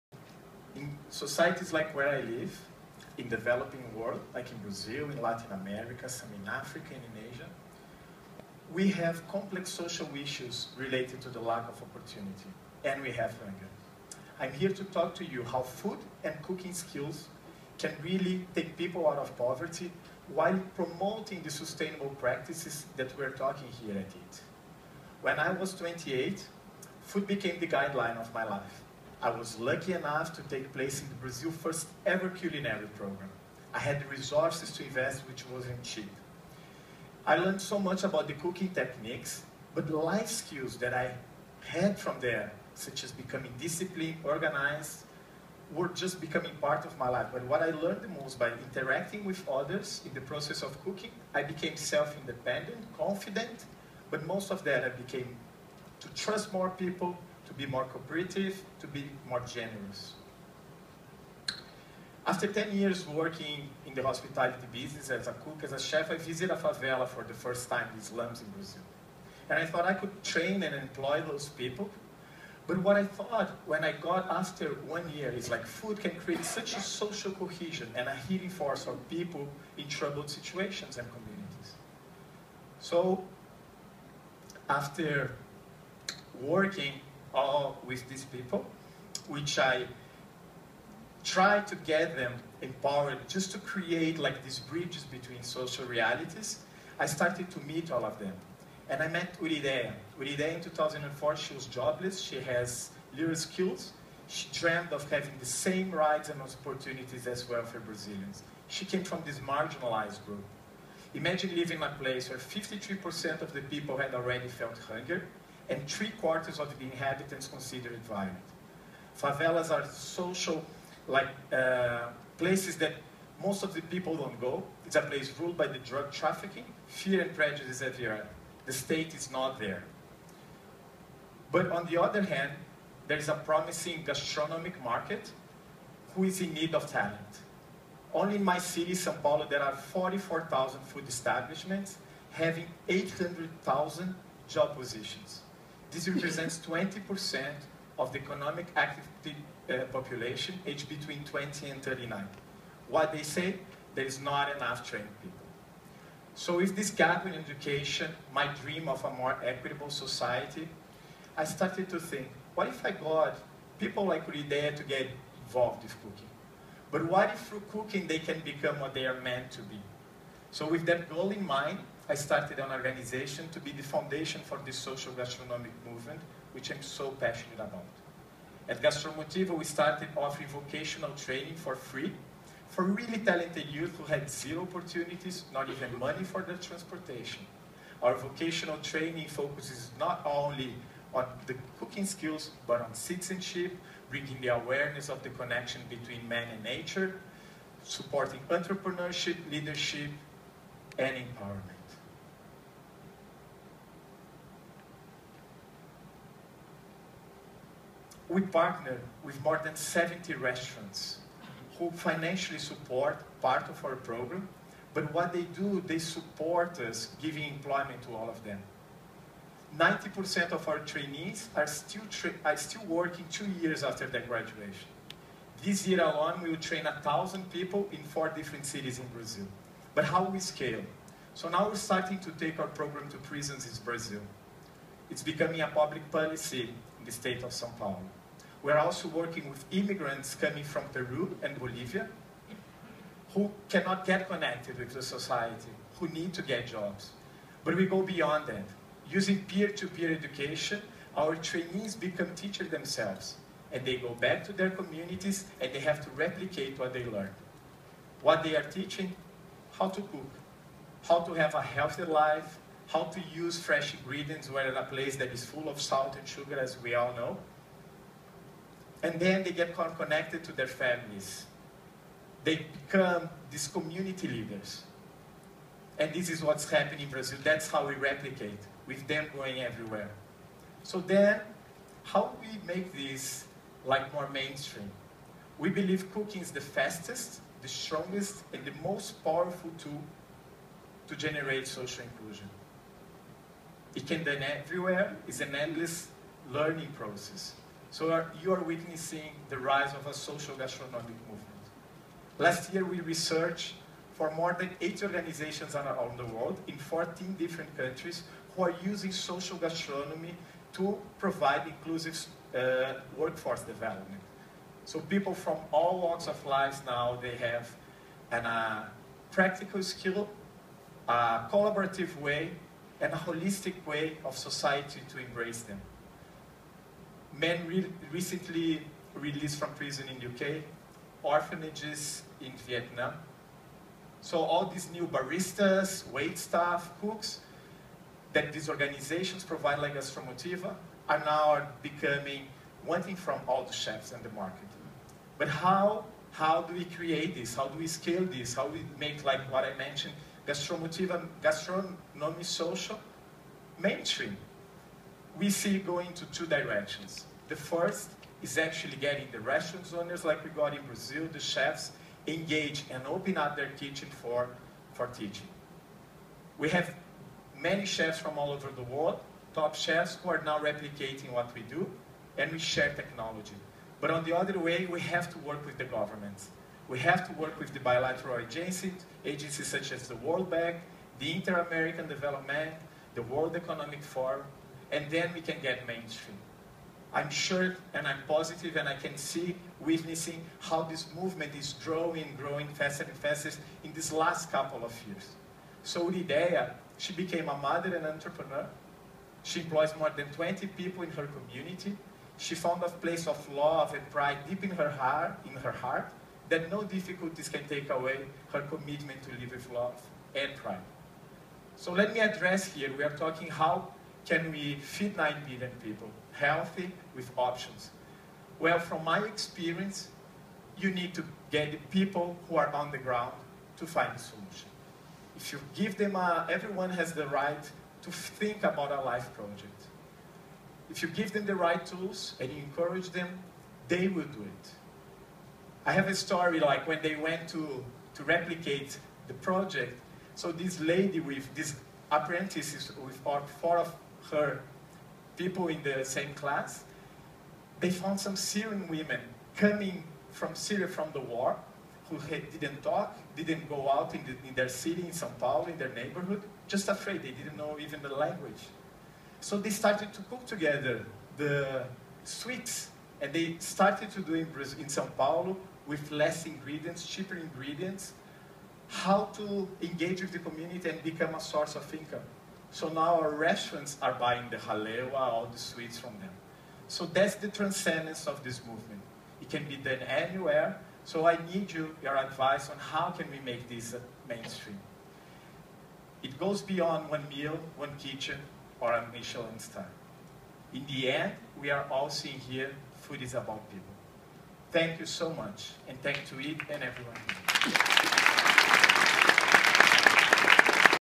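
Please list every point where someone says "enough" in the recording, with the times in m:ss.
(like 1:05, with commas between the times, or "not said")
0:29, 2:34.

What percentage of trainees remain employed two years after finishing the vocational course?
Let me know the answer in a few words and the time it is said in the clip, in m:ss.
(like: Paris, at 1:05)
90%, at 3:39.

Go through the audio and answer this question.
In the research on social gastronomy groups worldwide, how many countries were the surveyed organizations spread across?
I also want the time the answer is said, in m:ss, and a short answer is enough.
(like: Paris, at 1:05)
14, at 5:06.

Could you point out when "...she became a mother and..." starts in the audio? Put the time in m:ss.
6:36.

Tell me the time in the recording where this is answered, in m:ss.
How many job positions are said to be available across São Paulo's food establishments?
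2:22.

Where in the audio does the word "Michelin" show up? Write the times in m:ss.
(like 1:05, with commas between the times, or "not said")
8:09.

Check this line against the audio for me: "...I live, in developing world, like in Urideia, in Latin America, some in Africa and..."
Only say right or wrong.
wrong.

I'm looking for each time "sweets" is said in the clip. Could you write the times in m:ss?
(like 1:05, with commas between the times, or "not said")
7:42, 7:55.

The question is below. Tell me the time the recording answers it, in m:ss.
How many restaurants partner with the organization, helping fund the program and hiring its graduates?
3:29.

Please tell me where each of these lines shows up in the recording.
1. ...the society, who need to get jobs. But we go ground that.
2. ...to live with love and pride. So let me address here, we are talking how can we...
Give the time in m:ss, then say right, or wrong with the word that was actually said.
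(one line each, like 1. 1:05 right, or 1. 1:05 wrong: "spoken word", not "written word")
1. 4:04 wrong: "beyond", not "ground"
2. 6:49 right.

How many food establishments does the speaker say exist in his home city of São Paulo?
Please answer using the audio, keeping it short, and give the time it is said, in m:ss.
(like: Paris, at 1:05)
44,000, at 2:19.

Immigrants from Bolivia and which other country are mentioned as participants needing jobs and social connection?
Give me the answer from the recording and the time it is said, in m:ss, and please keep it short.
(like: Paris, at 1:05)
Peru, at 4:00.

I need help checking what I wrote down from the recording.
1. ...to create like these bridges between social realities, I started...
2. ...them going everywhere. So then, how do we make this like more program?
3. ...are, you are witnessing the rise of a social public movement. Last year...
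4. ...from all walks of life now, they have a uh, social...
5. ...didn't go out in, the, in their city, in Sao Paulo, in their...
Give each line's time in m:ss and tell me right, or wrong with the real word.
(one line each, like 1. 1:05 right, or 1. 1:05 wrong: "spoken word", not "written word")
1. 1:33 right
2. 4:39 wrong: "mainstream", not "program"
3. 4:58 wrong: "gastronomic", not "public"
4. 5:15 wrong: "practical", not "social"
5. 7:33 right.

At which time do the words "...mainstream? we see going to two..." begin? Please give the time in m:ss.
5:53.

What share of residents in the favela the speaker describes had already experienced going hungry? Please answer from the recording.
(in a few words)
53%.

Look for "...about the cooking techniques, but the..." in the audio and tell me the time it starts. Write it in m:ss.
0:38.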